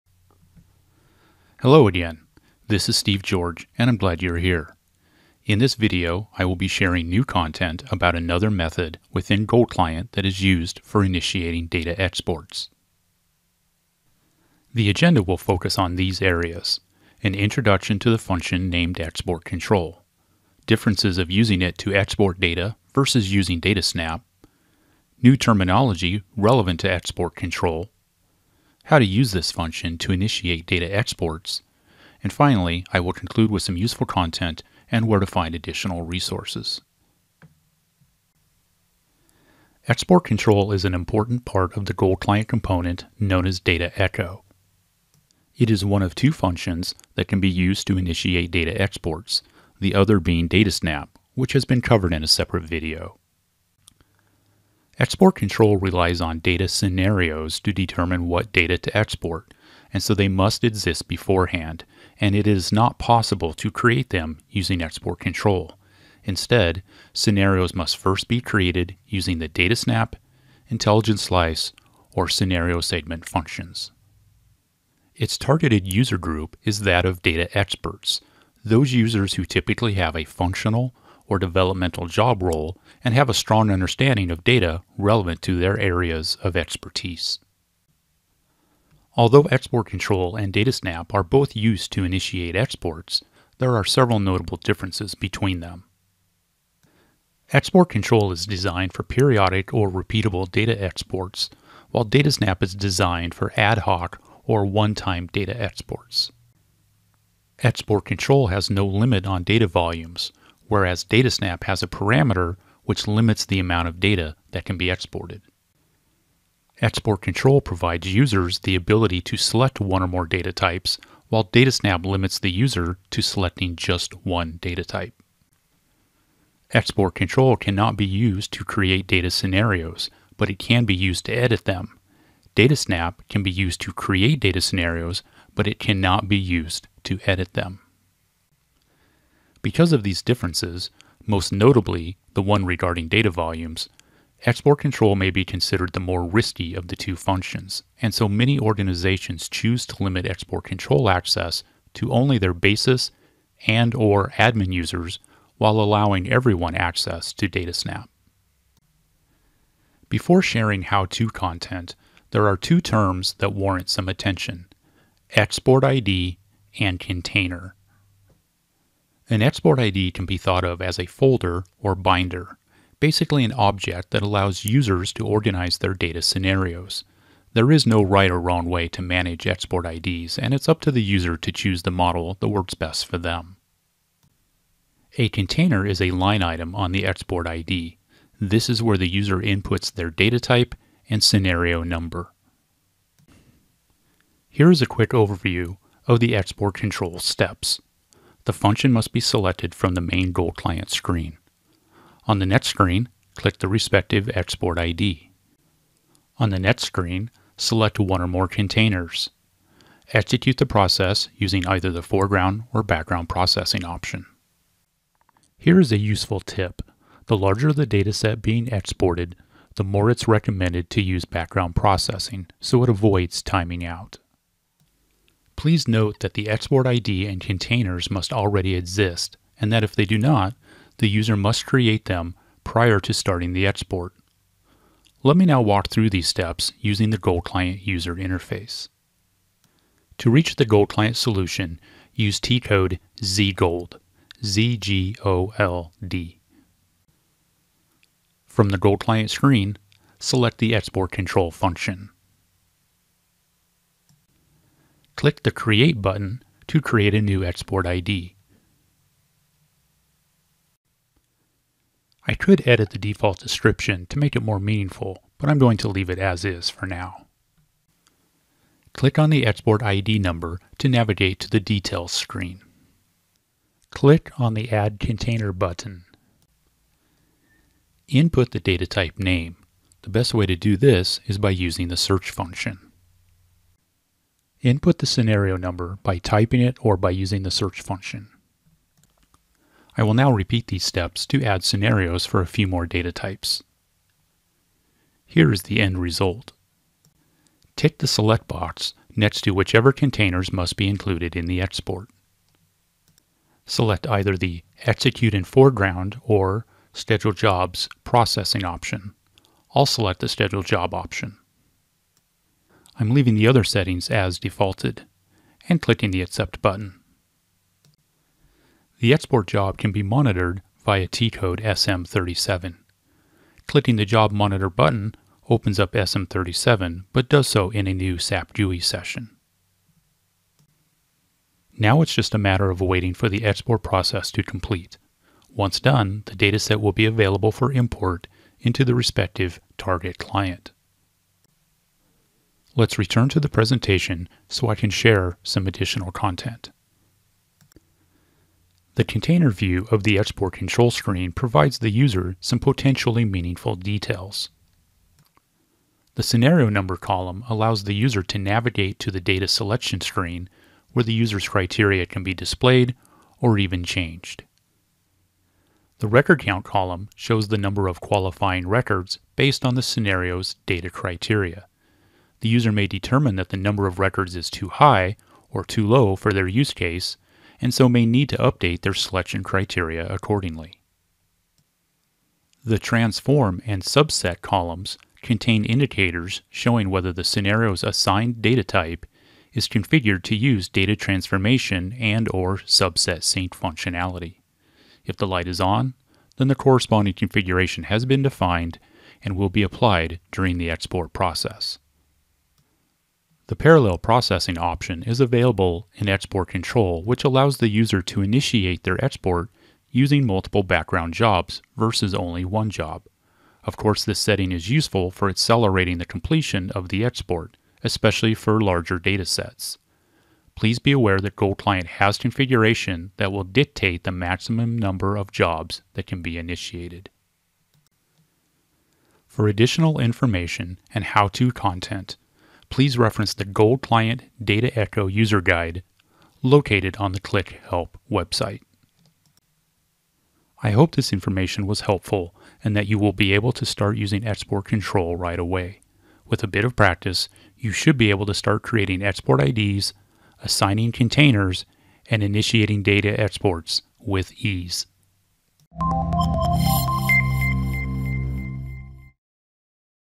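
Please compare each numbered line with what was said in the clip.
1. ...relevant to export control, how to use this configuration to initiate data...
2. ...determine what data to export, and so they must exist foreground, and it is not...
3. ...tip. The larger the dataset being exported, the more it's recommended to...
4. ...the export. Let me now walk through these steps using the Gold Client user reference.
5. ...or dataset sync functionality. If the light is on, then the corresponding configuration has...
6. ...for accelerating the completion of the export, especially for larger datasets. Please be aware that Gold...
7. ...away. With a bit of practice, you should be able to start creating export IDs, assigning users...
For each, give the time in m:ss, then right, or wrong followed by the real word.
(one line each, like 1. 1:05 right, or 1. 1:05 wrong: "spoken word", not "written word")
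1. 0:26 wrong: "function", not "configuration"
2. 0:57 wrong: "beforehand", not "foreground"
3. 3:36 right
4. 3:53 wrong: "interface", not "reference"
5. 6:32 wrong: "subset", not "dataset"
6. 6:55 right
7. 7:25 wrong: "containers", not "users".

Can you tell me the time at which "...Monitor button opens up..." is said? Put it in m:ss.
5:24.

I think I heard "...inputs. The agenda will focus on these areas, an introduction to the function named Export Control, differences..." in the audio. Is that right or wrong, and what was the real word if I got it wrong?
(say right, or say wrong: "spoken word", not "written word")
wrong: "exports", not "inputs".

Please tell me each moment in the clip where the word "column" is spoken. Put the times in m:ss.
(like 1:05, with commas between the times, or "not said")
5:56, 6:06, 6:24.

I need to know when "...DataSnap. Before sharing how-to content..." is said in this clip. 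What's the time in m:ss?
2:37.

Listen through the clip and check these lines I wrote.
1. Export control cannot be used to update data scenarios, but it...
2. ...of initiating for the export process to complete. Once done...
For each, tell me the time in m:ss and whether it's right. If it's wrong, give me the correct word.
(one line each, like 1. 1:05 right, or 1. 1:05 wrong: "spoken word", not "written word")
1. 2:06 wrong: "create", not "update"
2. 5:32 wrong: "waiting", not "initiating".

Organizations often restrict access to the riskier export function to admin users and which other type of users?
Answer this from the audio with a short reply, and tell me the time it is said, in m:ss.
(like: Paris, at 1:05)
basis, at 2:32.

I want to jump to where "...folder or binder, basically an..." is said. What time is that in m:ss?
2:51.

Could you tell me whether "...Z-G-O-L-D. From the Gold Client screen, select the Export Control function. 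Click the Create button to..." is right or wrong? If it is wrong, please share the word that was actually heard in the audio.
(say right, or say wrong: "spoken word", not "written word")
right.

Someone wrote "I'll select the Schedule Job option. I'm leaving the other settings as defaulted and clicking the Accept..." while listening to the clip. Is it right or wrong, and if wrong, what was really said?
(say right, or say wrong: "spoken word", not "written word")
right.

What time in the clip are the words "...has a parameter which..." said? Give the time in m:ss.
1:51.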